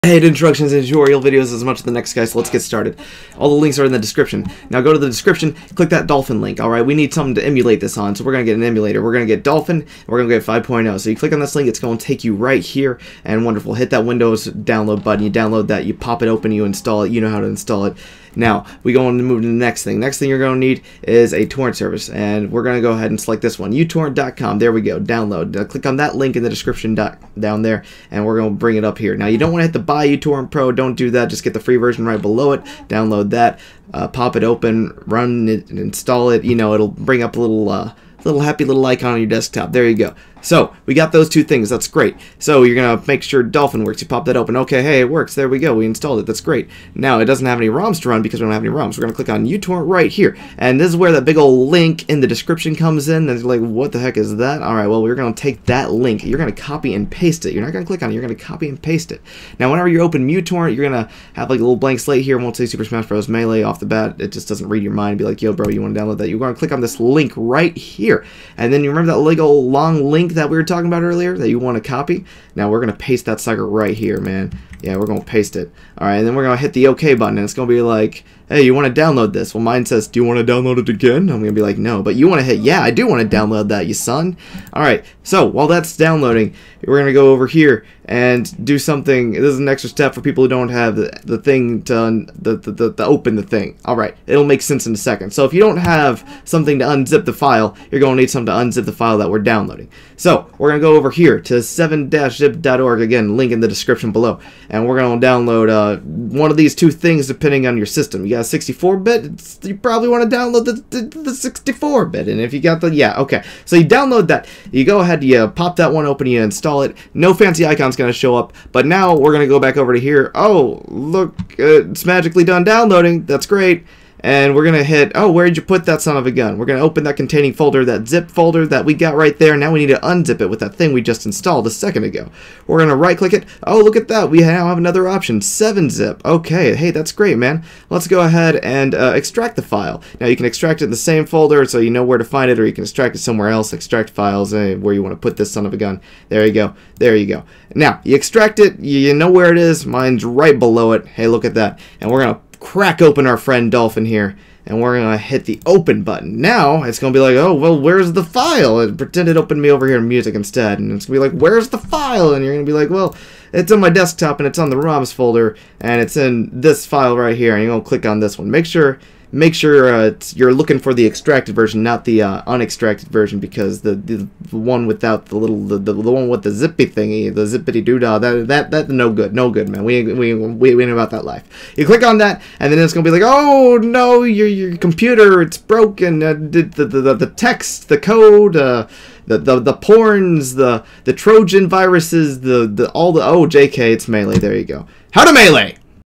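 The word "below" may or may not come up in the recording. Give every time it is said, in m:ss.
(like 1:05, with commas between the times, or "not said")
0:32, 1:44, 2:30.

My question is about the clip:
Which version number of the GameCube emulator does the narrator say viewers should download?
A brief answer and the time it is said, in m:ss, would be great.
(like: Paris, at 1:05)
5.0, at 0:10.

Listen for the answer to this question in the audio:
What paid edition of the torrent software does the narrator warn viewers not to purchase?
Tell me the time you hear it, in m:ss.
0:30.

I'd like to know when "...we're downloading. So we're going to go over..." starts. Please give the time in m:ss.
1:39.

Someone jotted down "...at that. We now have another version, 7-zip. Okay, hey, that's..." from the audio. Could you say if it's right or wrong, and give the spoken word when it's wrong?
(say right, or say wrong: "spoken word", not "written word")
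wrong: "option", not "version".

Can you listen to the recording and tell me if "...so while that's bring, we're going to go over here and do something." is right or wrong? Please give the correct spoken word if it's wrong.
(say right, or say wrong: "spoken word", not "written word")
wrong: "downloading", not "bring".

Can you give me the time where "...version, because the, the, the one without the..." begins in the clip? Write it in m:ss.
2:53.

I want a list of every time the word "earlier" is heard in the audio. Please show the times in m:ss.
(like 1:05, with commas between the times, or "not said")
1:11.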